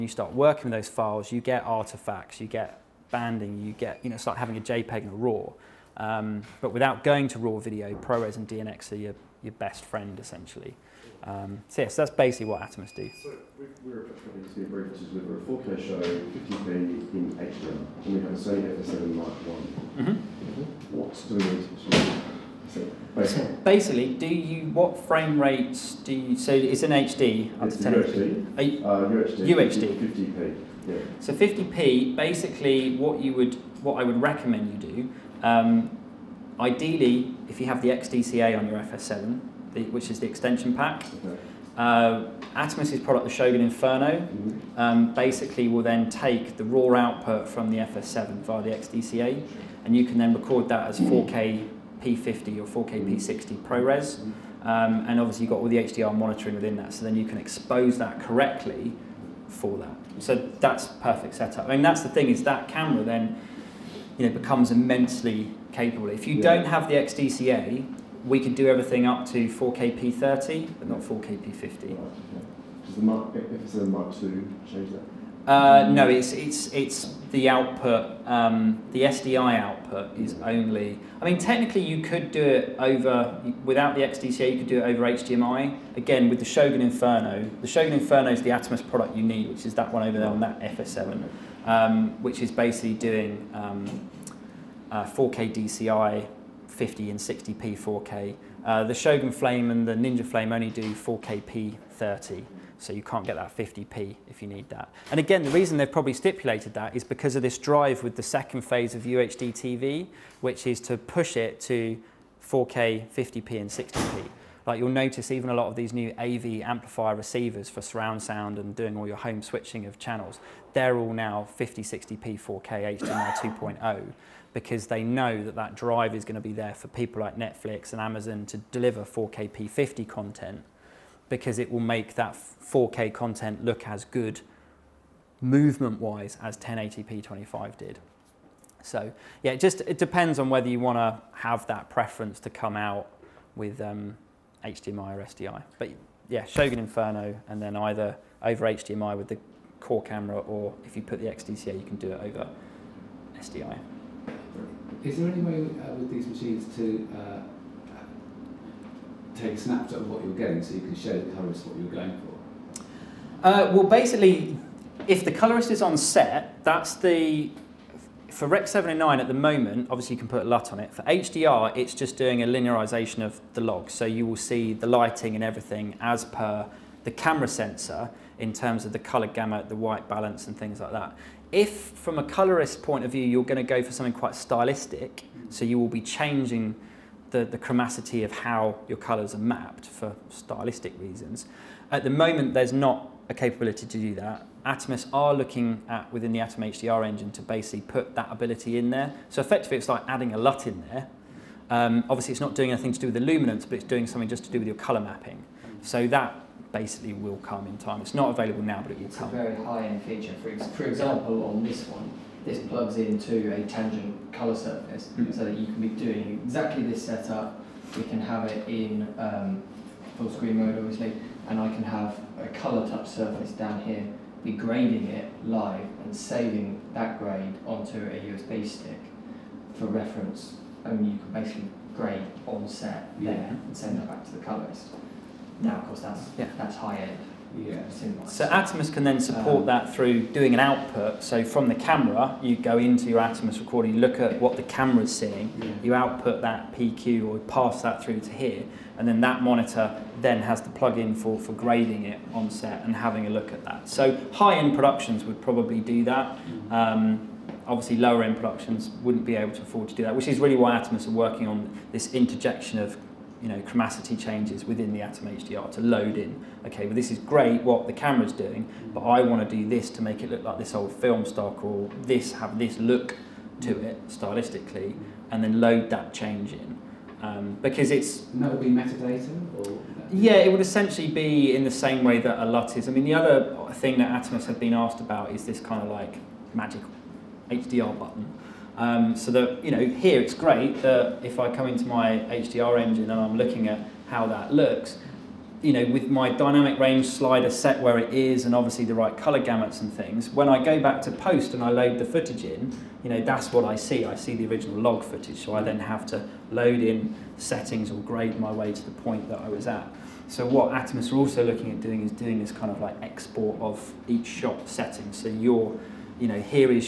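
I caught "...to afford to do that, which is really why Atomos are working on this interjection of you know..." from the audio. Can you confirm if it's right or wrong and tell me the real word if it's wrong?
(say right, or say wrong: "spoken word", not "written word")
right.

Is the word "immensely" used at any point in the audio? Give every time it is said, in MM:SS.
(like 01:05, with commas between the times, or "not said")
01:04.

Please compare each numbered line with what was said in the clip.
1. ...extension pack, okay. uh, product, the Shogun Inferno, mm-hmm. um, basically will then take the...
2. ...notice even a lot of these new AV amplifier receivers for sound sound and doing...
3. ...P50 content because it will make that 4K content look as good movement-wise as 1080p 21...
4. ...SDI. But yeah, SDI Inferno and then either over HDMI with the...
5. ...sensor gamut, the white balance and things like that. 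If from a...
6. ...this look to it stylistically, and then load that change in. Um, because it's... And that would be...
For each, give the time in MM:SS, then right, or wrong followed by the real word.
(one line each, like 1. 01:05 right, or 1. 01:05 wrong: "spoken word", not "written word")
1. 00:40 right
2. 01:54 wrong: "surround", not "sound"
3. 02:09 wrong: "25", not "21"
4. 02:25 wrong: "Shogun", not "SDI"
5. 02:58 wrong: "color", not "sensor"
6. 04:32 right.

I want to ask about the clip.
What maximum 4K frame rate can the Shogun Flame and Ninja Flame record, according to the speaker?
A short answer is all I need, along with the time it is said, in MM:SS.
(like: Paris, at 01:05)
4K P30, at 01:40.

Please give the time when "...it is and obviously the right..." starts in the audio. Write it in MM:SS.
04:57.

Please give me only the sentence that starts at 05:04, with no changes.
I see the original log footage.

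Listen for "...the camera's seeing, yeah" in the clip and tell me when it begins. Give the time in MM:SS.
04:04.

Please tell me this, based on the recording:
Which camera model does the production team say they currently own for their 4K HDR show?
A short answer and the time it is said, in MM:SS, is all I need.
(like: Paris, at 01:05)
Sony FS7 Mark One, at 00:18.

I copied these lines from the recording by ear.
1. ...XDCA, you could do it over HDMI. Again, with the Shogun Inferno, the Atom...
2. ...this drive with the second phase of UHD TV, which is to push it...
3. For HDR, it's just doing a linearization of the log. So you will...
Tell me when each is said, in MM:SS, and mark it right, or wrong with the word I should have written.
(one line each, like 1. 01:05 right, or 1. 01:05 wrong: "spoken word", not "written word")
1. 01:24 wrong: "Shogun", not "Atom"
2. 01:47 right
3. 02:50 right.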